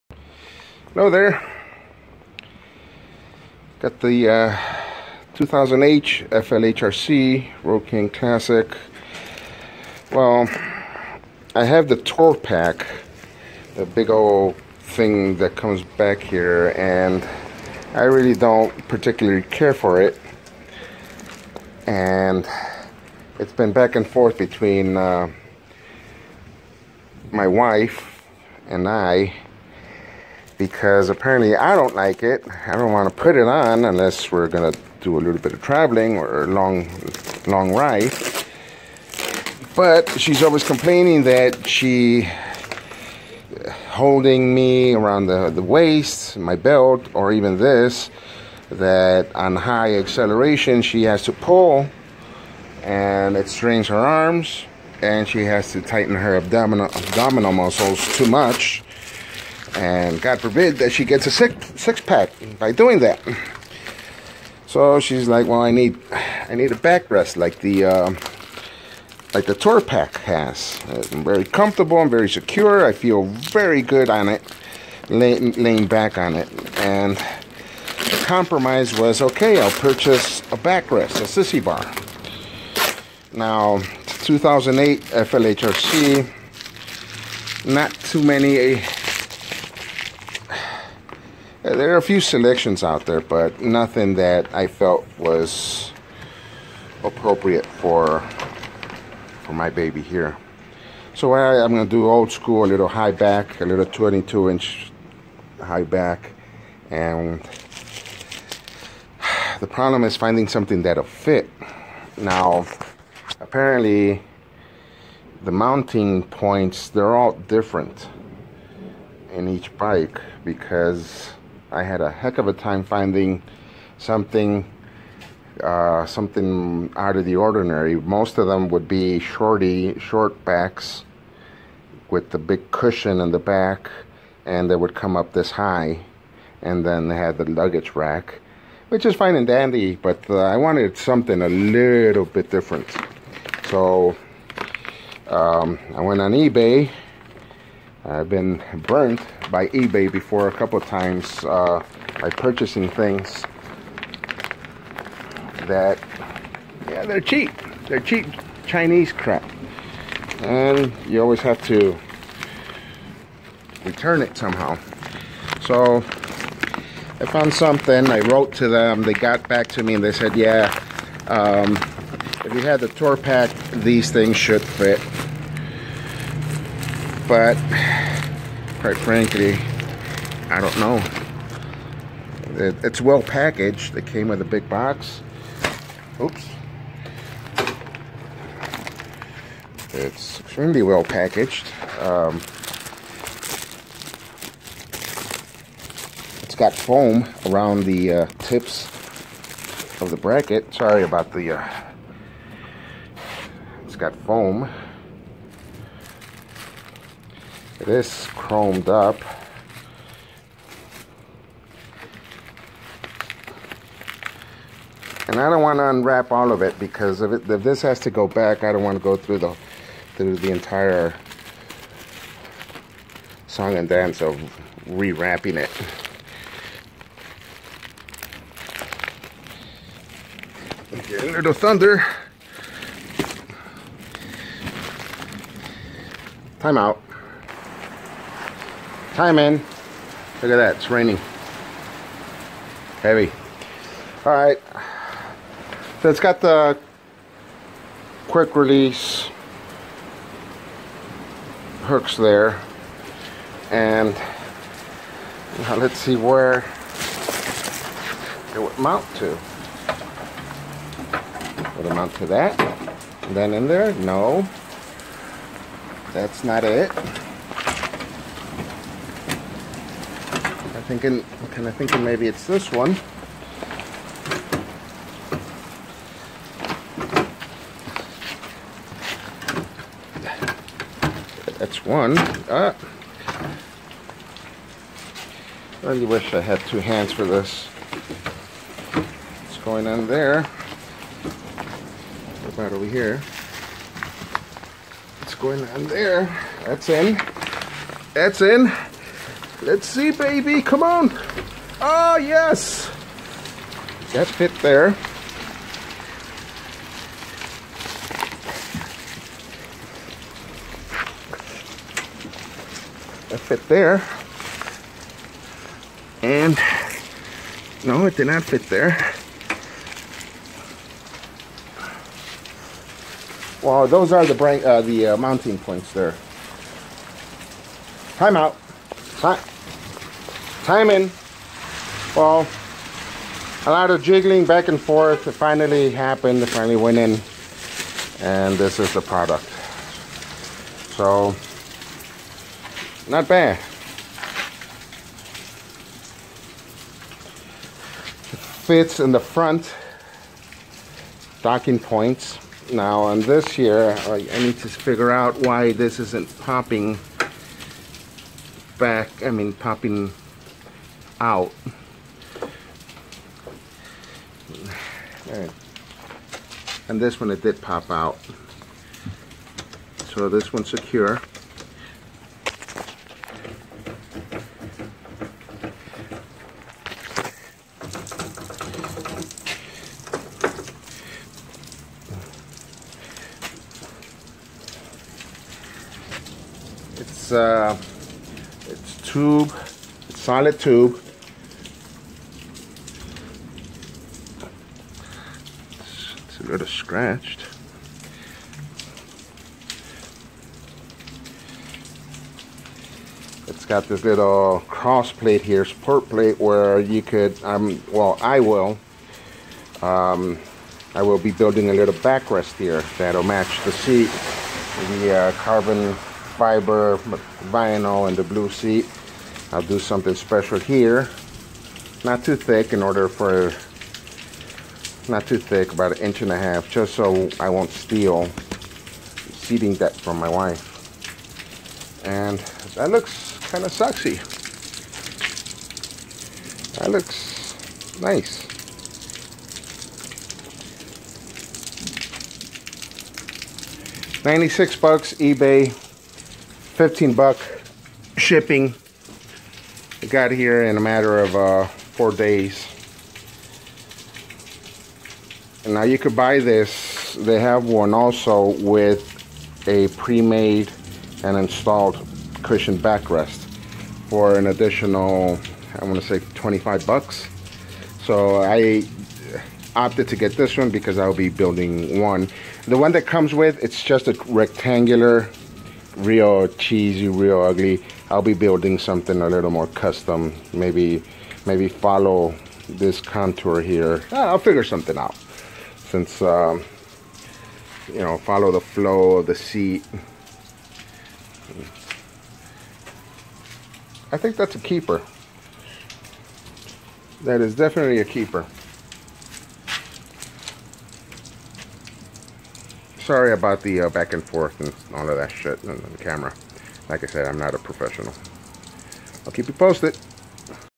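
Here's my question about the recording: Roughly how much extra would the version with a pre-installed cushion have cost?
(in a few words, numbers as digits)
$25.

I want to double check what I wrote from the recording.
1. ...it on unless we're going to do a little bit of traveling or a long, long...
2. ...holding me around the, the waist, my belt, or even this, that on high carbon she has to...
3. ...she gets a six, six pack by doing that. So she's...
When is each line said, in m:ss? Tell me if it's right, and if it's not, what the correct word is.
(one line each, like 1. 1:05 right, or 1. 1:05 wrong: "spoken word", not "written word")
1. 0:33 right
2. 0:43 wrong: "acceleration", not "carbon"
3. 1:00 right.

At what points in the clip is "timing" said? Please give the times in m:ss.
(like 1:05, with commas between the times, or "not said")
5:30.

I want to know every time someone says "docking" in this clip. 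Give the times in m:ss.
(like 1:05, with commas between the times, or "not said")
5:51.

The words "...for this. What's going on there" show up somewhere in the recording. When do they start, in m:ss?
4:47.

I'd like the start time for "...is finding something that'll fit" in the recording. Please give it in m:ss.
1:50.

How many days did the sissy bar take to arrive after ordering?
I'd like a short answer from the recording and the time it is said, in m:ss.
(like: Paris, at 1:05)
4, at 7:31.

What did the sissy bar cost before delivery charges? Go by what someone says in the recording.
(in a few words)
$96.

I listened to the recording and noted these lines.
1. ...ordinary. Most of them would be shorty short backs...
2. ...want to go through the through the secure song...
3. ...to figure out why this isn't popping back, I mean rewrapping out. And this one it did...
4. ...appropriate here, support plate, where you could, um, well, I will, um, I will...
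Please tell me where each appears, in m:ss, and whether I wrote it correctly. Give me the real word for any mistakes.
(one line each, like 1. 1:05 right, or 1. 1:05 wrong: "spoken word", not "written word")
1. 2:07 right
2. 3:38 wrong: "entire", not "secure"
3. 5:54 wrong: "popping", not "rewrapping"
4. 6:45 wrong: "plate", not "appropriate".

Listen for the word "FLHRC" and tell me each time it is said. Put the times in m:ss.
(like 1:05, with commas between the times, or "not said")
0:06, 1:25.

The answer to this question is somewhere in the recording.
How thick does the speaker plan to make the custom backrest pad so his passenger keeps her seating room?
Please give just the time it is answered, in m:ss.
7:05.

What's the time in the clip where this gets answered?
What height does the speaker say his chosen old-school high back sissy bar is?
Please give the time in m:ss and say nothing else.
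1:43.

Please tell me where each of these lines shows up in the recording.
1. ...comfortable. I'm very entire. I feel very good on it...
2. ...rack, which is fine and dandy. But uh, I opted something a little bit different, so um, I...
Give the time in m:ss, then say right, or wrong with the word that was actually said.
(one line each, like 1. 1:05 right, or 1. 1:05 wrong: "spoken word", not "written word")
1. 1:11 wrong: "secure", not "entire"
2. 2:17 wrong: "wanted", not "opted".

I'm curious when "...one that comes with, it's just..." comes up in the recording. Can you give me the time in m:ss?
7:52.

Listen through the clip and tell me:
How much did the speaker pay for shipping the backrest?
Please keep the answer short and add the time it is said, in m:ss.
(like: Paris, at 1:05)
$15, at 7:25.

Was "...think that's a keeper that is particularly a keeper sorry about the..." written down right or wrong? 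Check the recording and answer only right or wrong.
wrong.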